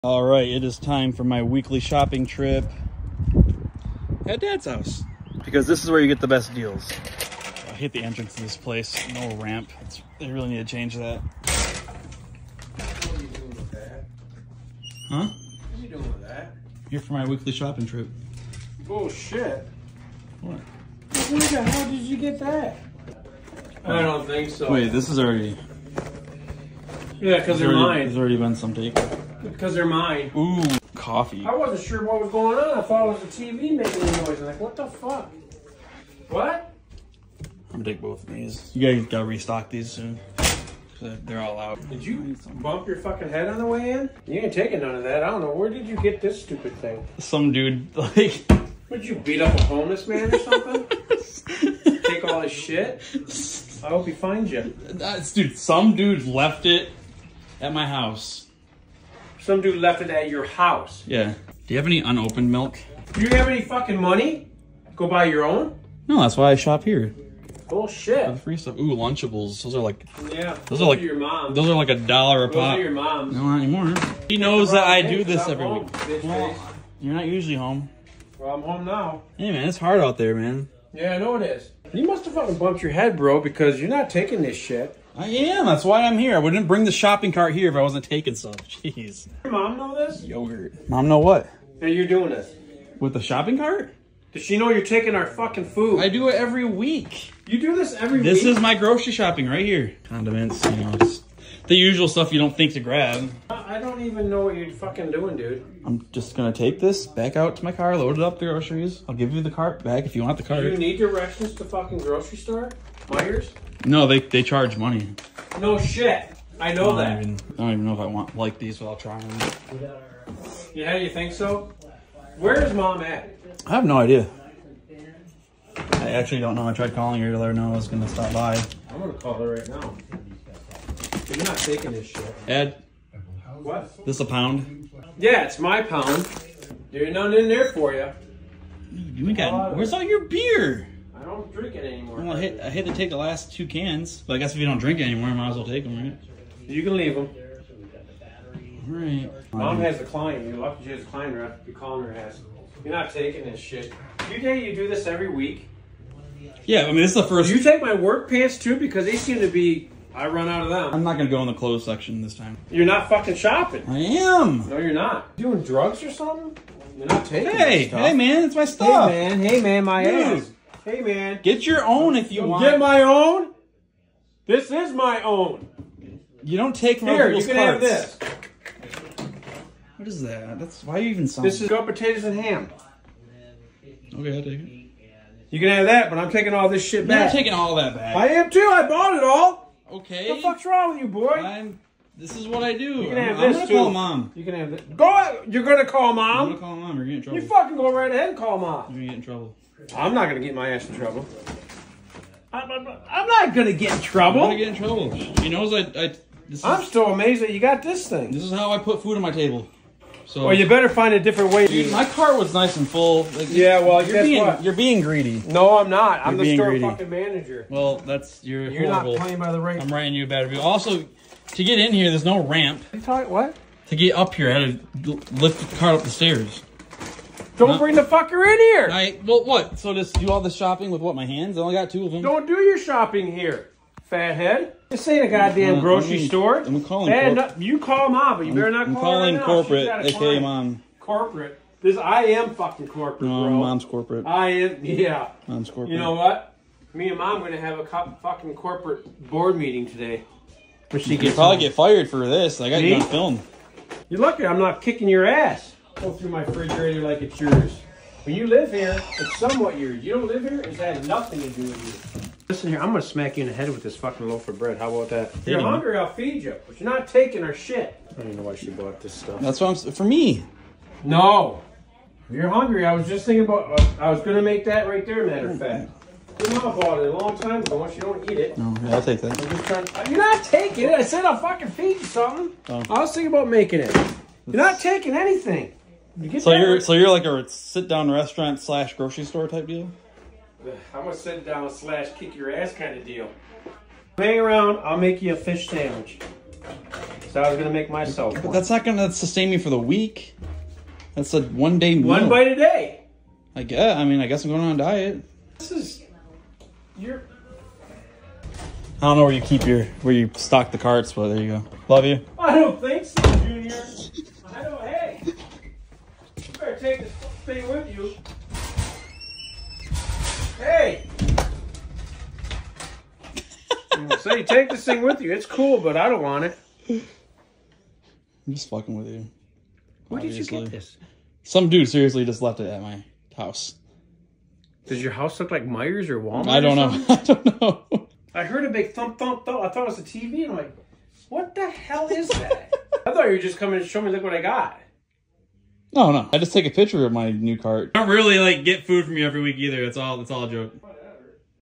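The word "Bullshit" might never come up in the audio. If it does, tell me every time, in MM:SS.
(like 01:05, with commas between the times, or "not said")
00:18, 01:07.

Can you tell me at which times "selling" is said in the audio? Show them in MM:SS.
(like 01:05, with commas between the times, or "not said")
03:01.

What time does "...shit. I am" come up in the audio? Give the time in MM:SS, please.
01:24.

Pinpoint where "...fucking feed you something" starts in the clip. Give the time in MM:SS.
04:41.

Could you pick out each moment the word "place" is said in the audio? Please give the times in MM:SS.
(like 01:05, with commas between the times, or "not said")
00:08.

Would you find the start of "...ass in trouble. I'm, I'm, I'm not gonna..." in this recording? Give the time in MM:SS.
03:20.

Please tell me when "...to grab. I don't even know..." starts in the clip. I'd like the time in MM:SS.
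01:42.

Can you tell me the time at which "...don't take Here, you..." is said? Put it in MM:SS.
02:56.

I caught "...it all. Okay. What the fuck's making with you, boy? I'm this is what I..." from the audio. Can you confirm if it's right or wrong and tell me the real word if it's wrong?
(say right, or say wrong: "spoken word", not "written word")
wrong: "wrong", not "making".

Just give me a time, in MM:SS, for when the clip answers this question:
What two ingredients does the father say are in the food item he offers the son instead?
03:01.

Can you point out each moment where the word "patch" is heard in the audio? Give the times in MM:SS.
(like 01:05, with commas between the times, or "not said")
not said.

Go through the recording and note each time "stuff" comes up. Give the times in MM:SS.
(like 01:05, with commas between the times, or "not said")
01:08, 01:42, 02:48, 04:29.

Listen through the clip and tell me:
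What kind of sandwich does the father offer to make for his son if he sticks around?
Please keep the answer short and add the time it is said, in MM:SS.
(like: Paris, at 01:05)
fish sandwich, at 04:55.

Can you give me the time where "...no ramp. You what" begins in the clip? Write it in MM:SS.
03:42.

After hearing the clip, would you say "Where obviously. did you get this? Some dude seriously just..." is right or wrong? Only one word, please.
right.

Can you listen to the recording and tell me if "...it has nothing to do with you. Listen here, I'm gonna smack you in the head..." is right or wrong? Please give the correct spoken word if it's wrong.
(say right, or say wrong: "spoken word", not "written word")
right.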